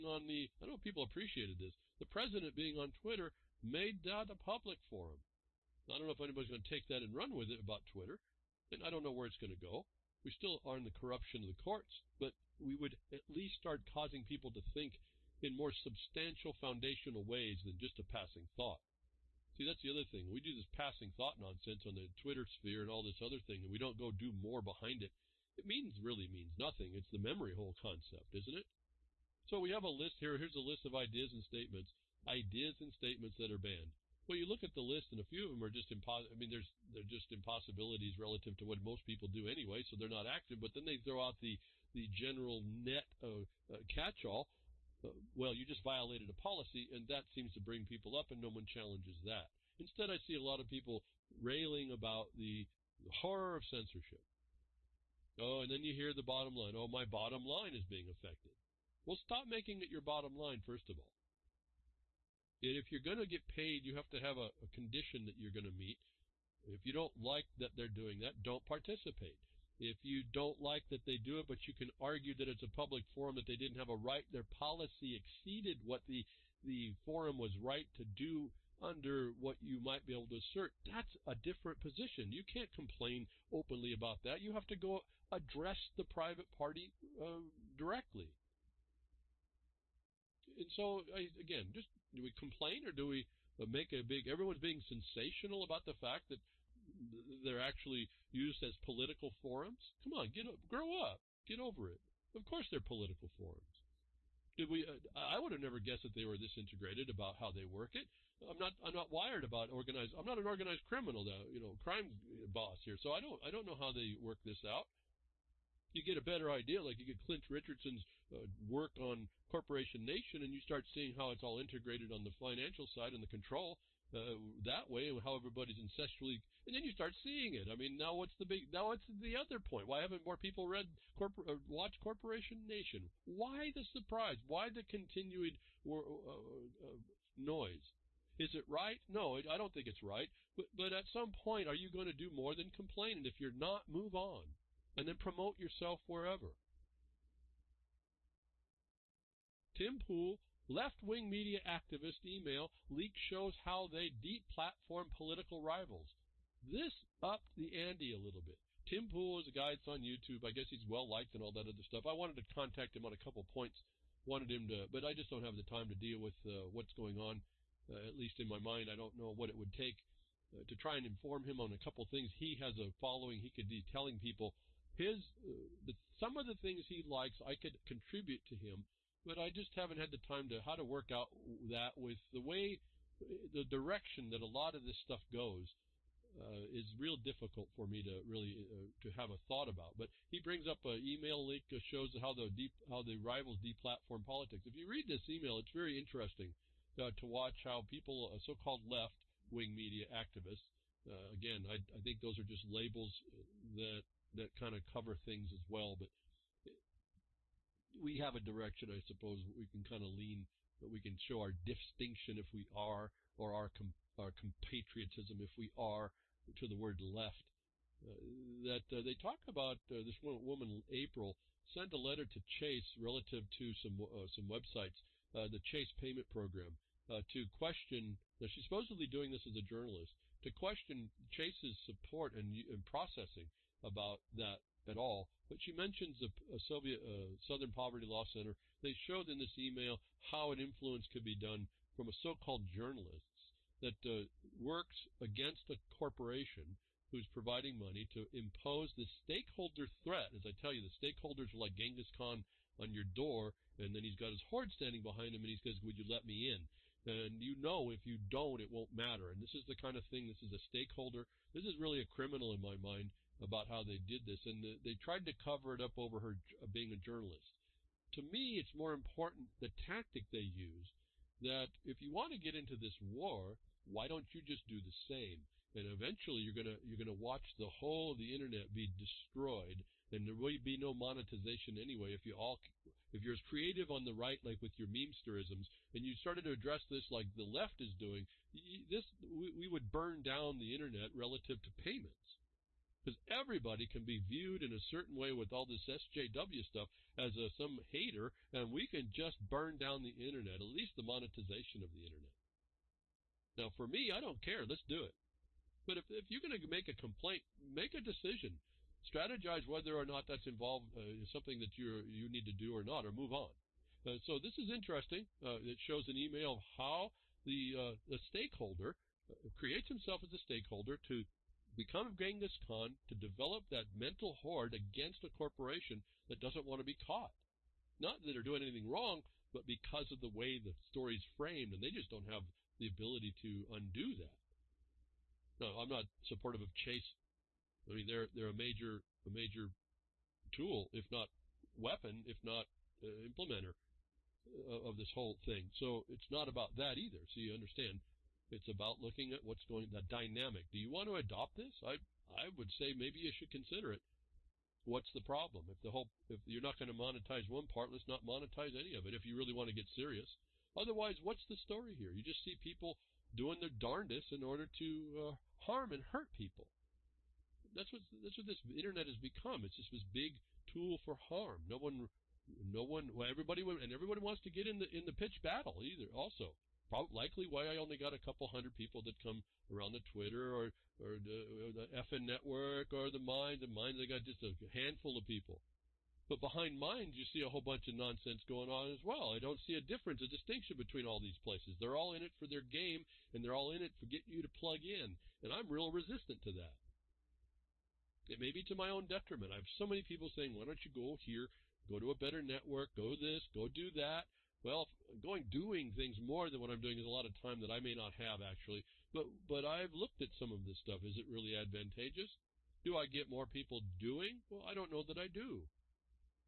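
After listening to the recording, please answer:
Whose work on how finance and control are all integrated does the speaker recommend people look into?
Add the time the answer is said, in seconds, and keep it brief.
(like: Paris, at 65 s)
Clint Richardson, at 117 s.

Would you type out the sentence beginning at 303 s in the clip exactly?
Now, for me, I don't care.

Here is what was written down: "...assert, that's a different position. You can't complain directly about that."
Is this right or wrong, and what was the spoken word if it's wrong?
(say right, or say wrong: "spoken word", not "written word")
wrong: "openly", not "directly".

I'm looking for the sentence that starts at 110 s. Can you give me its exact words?
I'm not an organized criminal, though, you know, crime boss here.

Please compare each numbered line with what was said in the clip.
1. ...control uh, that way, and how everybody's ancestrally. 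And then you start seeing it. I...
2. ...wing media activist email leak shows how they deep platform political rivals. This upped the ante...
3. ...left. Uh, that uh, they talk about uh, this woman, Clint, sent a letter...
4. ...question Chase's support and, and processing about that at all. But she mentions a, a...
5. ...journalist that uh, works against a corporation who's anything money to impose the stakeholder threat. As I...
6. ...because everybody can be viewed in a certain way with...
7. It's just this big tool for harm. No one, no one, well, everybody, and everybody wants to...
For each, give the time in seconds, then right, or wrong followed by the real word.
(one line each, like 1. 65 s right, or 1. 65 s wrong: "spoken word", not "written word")
1. 123 s right
2. 151 s right
3. 217 s wrong: "April", not "Clint"
4. 230 s right
5. 242 s wrong: "providing", not "anything"
6. 293 s right
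7. 369 s right.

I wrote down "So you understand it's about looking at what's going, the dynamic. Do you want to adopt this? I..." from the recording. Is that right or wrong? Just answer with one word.
right.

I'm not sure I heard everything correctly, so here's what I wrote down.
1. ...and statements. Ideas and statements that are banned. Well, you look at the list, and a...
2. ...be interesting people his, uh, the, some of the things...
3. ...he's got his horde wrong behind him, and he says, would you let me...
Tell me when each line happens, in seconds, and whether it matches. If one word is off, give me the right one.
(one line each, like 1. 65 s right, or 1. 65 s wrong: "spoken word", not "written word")
1. 31 s right
2. 173 s wrong: "telling", not "interesting"
3. 254 s wrong: "standing", not "wrong".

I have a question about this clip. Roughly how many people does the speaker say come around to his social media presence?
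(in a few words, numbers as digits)
A couple hundred.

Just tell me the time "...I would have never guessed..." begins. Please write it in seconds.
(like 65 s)
105 s.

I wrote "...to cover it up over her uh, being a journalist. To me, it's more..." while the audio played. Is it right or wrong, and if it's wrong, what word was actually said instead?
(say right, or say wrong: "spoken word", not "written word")
right.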